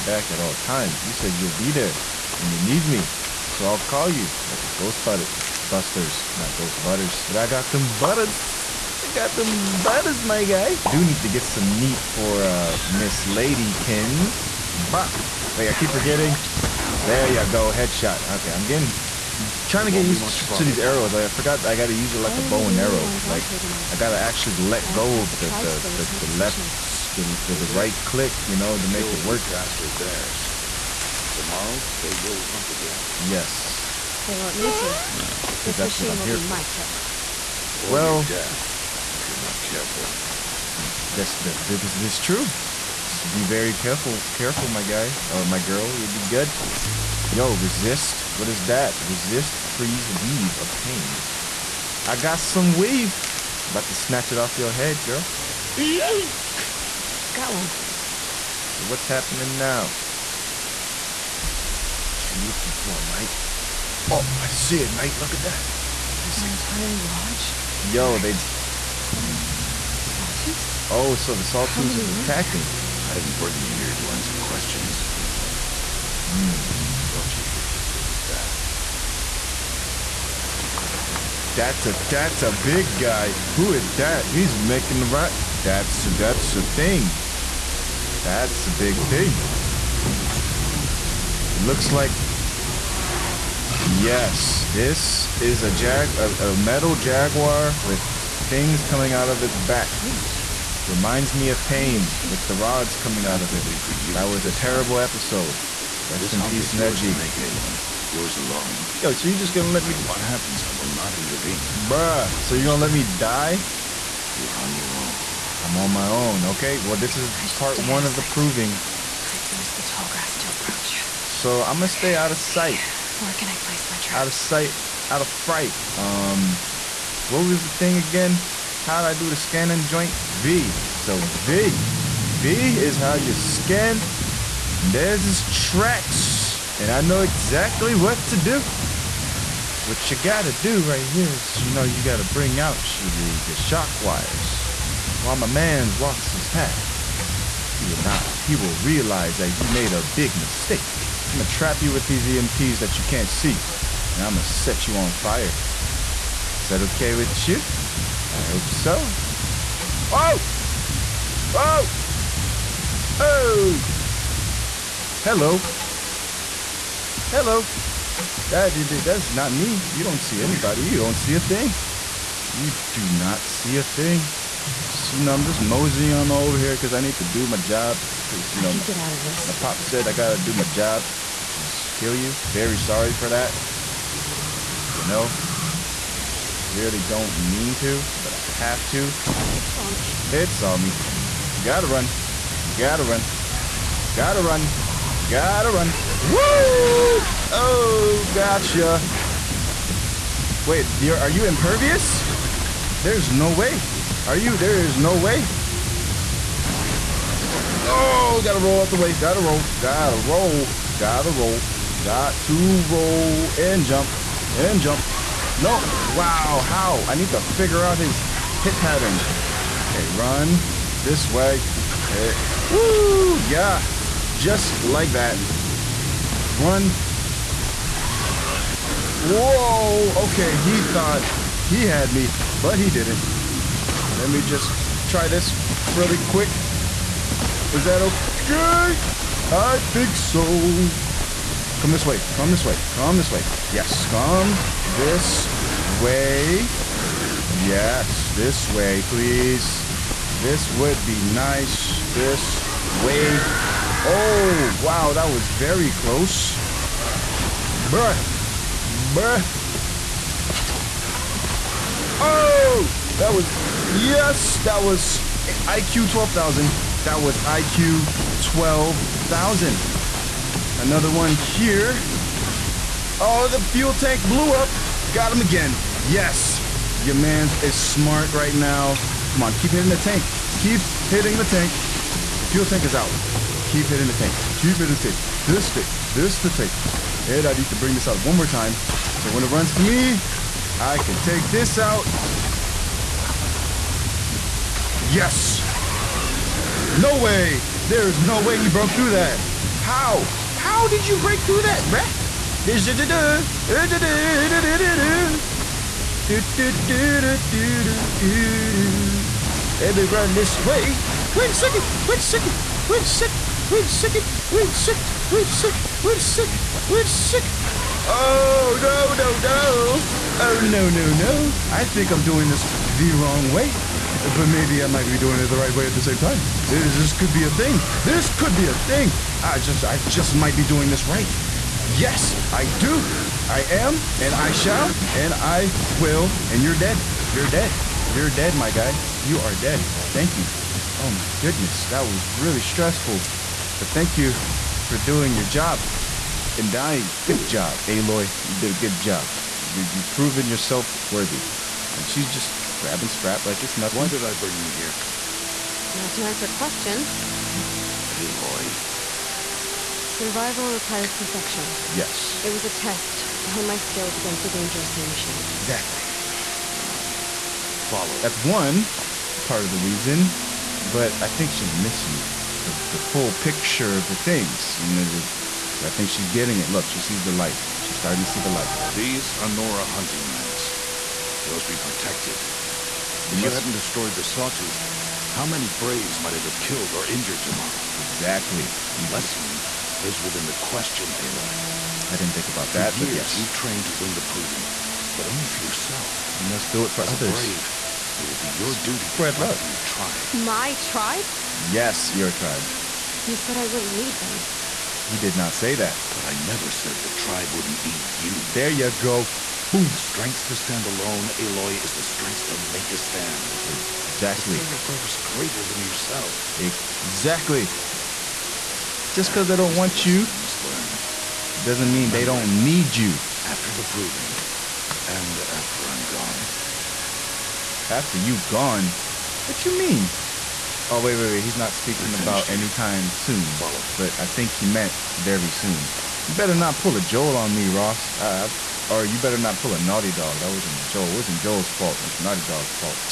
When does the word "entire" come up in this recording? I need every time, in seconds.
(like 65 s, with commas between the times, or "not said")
66 s.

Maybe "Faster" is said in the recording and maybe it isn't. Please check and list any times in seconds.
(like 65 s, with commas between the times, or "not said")
29 s.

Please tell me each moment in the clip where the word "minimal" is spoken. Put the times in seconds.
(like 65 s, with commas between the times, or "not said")
not said.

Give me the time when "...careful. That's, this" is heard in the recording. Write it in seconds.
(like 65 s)
39 s.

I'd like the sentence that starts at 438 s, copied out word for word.
Uh, or you better not pull a Naughty Dog.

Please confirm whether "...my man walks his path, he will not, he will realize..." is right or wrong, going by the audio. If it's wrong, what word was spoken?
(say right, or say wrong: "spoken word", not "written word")
right.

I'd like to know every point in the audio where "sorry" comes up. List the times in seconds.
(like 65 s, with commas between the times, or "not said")
182 s.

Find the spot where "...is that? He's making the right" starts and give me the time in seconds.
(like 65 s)
83 s.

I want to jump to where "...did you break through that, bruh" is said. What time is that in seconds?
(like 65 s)
300 s.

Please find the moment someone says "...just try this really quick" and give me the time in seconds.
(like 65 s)
234 s.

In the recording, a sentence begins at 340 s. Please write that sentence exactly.
Oh my goodness, that was really stressful.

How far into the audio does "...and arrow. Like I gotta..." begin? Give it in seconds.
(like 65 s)
22 s.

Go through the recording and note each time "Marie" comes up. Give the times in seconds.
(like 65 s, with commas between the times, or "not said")
not said.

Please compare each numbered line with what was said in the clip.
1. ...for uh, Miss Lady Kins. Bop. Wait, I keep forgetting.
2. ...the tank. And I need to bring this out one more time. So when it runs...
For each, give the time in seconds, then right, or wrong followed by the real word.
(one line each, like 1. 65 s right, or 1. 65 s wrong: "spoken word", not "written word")
1. 11 s right
2. 286 s right.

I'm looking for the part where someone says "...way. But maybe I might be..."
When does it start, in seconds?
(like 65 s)
323 s.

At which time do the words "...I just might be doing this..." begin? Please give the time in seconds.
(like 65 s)
329 s.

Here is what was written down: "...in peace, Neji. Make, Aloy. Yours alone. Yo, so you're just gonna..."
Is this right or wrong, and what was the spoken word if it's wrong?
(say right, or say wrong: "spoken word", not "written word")
right.